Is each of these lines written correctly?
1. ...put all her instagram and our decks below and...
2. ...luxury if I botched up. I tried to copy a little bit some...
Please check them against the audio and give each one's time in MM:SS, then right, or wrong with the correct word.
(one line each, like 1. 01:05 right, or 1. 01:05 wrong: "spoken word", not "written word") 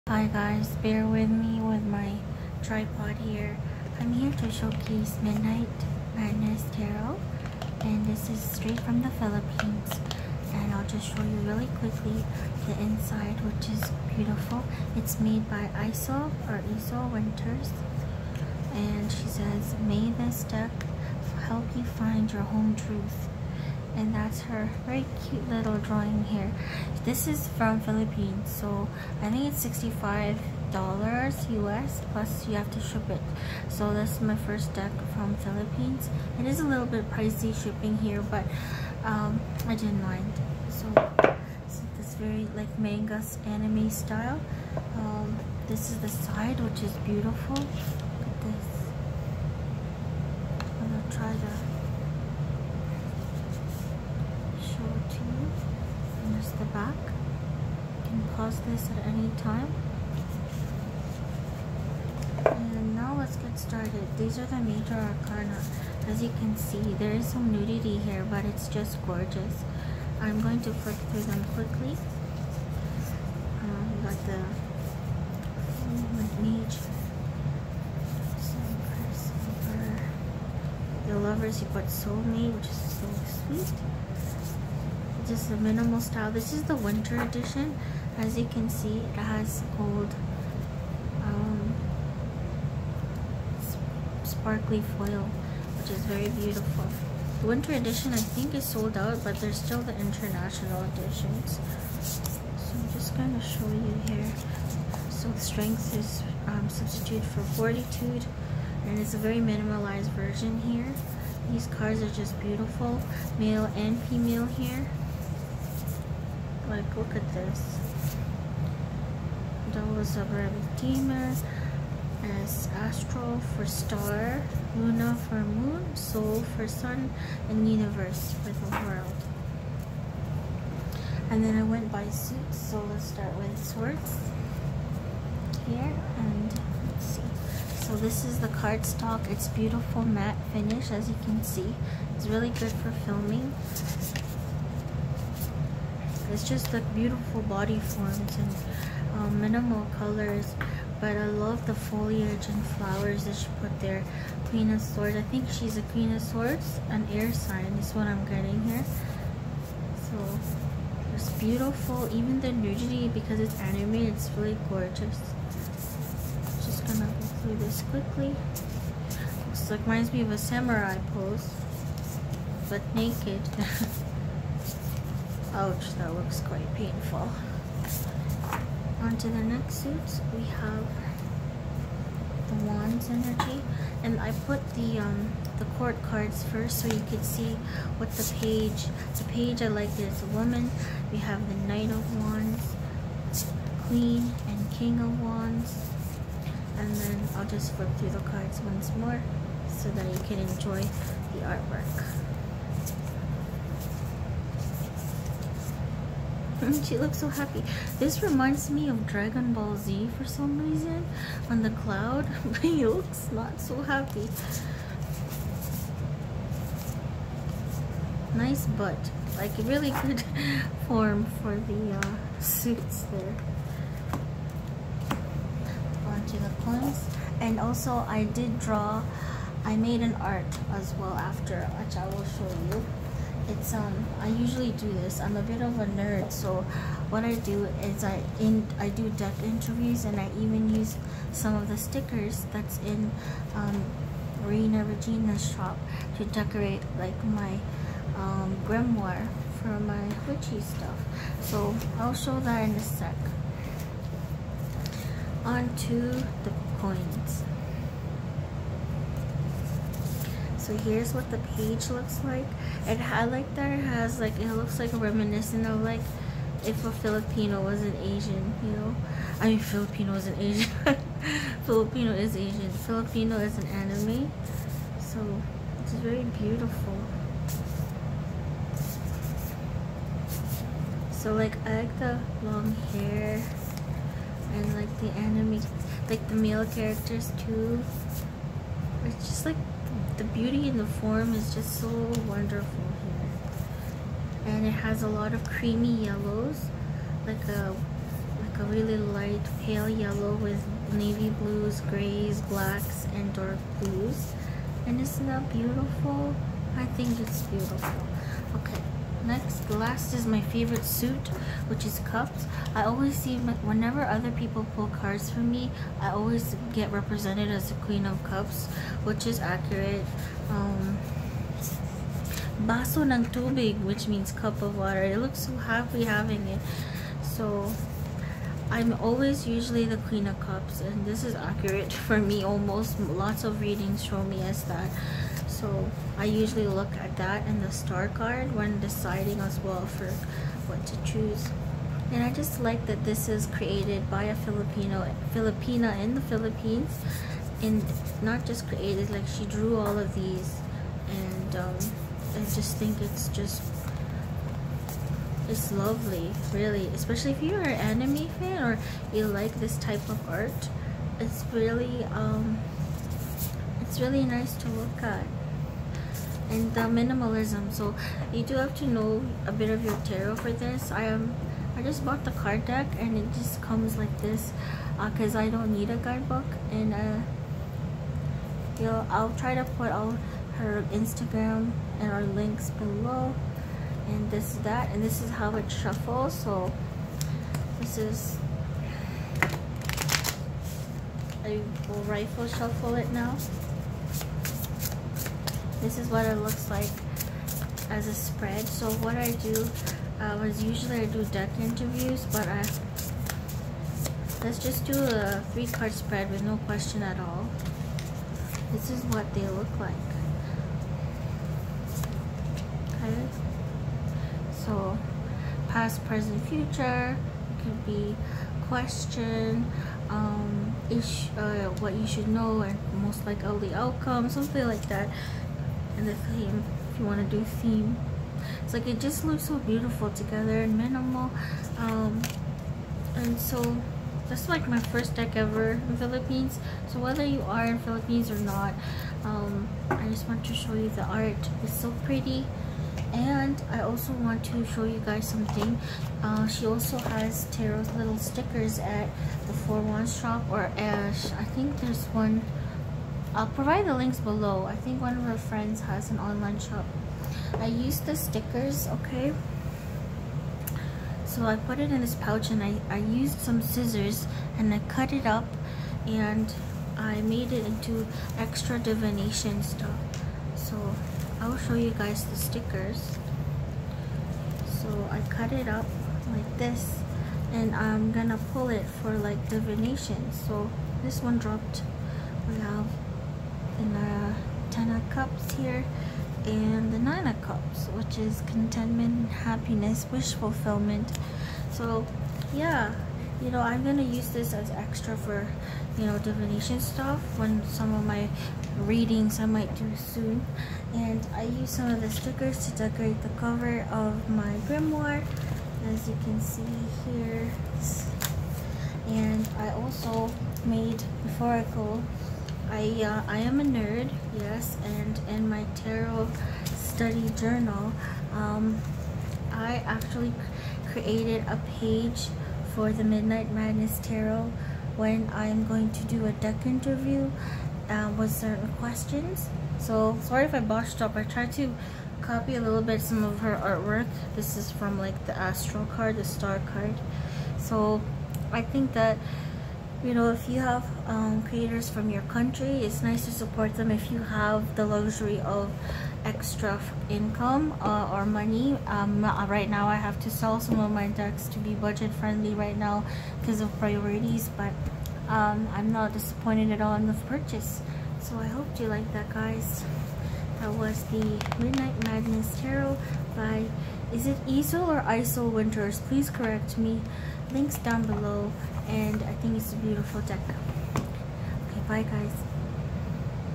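1. 06:19 wrong: "links", not "decks"
2. 08:50 wrong: "sorry", not "luxury".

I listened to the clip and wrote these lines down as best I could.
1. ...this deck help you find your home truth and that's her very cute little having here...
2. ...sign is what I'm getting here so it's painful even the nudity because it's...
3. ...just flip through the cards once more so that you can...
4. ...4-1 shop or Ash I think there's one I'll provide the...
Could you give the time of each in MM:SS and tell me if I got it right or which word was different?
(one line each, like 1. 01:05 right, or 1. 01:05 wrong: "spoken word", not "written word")
1. 00:20 wrong: "drawing", not "having"
2. 02:37 wrong: "beautiful", not "painful"
3. 03:17 right
4. 07:29 right.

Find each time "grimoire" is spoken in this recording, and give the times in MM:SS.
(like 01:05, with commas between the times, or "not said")
04:08, 08:24.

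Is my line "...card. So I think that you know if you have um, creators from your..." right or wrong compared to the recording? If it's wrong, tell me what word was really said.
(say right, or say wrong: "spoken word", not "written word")
right.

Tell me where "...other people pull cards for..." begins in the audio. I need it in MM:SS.
05:14.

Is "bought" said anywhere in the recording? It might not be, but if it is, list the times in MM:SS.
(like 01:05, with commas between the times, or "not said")
06:12.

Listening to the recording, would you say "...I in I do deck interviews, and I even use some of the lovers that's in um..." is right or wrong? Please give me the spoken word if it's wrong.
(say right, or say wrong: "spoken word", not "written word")
wrong: "stickers", not "lovers".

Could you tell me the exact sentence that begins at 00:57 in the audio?
You can pause this at any time.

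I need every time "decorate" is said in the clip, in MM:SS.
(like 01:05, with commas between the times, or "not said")
04:06, 08:22.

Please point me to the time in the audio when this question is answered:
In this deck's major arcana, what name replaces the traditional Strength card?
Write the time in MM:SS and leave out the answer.
01:47.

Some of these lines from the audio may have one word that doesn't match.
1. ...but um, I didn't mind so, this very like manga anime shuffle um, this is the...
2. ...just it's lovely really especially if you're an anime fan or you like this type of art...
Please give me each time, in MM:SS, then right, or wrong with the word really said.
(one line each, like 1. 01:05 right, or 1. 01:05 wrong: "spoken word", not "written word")
1. 00:38 wrong: "style", not "shuffle"
2. 05:53 right.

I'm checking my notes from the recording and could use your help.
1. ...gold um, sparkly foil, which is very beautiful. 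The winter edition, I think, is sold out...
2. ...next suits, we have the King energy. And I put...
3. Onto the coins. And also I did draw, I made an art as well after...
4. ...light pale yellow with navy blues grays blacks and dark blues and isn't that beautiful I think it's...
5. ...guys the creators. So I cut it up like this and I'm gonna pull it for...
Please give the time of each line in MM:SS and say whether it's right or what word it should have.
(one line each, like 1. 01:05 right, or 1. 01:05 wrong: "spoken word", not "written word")
1. 01:29 right
2. 02:59 wrong: "Wands", not "King"
3. 03:46 right
4. 04:58 right
5. 07:51 wrong: "stickers", not "creators".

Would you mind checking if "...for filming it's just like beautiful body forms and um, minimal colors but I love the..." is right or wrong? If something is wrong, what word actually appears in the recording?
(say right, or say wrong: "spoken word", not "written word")
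right.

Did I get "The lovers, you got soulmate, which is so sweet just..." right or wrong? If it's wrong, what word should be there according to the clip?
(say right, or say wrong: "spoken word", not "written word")
right.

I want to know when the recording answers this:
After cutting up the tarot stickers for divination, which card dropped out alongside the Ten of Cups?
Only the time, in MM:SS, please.
08:06.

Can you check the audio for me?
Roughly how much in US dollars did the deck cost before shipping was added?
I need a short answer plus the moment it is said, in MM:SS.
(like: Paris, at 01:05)
65 dollars, at 00:29.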